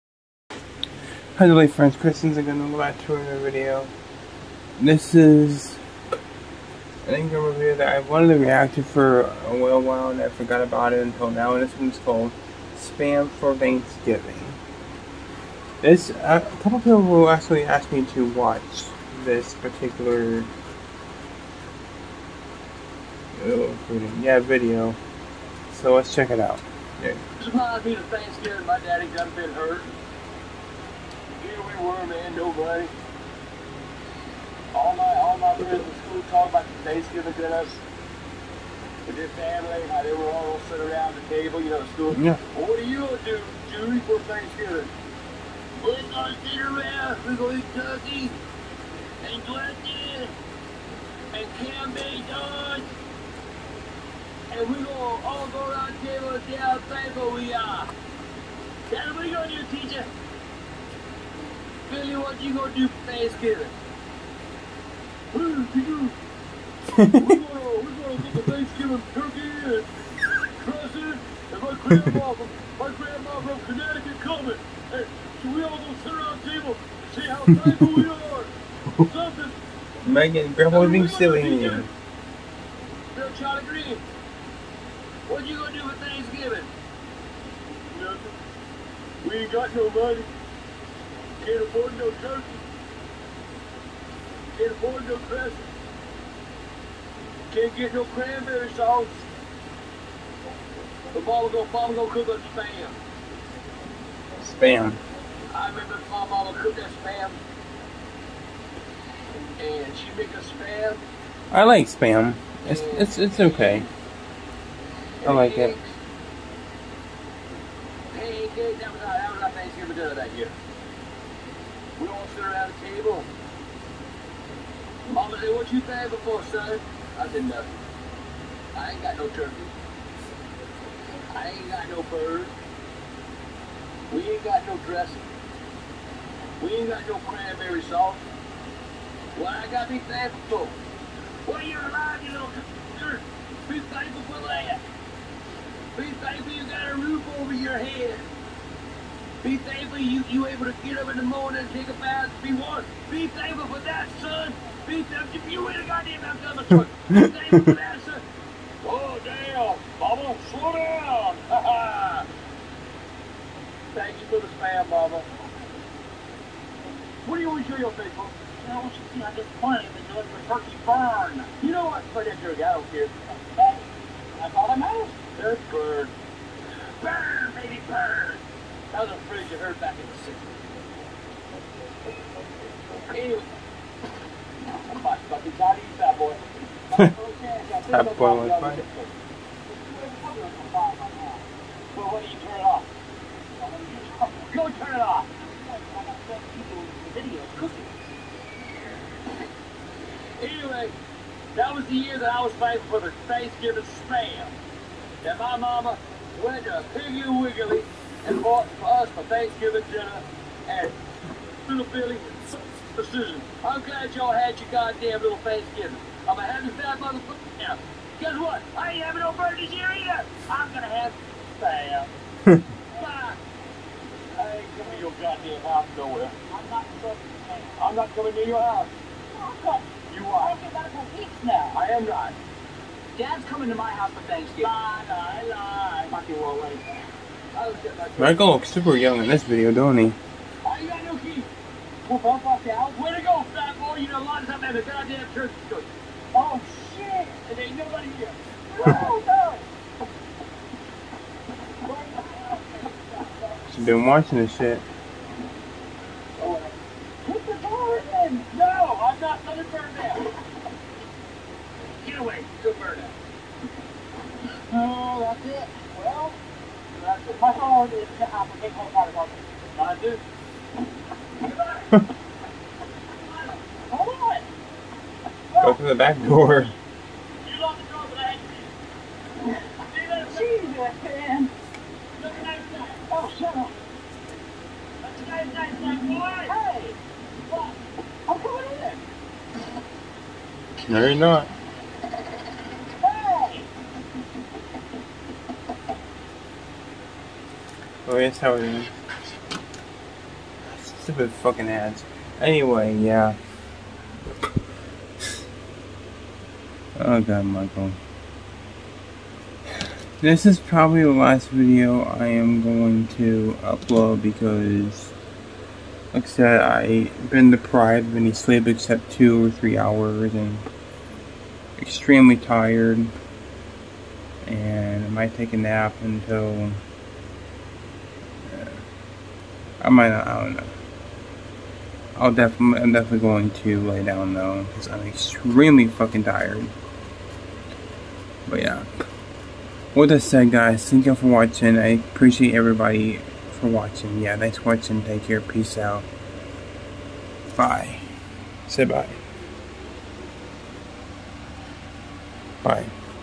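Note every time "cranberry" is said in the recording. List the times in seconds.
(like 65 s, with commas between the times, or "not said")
98 s, 137 s.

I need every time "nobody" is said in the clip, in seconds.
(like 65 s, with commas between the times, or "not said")
32 s, 247 s.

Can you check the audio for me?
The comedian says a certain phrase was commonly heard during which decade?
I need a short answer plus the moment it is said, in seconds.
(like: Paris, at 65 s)
the 60s, at 180 s.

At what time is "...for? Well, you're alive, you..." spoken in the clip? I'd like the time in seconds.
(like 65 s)
140 s.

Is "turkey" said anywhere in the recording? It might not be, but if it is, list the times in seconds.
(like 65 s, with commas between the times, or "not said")
47 s, 69 s, 92 s, 129 s, 170 s.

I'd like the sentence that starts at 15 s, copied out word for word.
This, uh, a couple people will actually ask me to watch this particular oh, yeah, video.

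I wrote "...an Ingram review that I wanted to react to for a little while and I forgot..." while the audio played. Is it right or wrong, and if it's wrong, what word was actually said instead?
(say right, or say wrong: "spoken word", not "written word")
right.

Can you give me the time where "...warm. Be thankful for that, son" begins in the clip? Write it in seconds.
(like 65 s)
152 s.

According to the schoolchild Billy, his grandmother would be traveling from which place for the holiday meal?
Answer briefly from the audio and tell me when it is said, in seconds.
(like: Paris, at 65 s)
Connecticut, at 73 s.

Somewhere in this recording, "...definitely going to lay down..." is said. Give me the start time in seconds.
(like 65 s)
332 s.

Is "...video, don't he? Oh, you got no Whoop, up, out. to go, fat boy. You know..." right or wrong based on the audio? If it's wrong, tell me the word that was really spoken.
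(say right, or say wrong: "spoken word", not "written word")
right.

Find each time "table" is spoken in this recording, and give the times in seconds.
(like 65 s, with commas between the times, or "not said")
41 s, 56 s, 76 s, 122 s.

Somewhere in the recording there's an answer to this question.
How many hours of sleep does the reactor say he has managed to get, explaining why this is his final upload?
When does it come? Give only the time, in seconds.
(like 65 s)
319 s.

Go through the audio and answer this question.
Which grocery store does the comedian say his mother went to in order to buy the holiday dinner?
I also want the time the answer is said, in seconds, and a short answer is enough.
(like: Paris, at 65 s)
Piggly Wiggly, at 206 s.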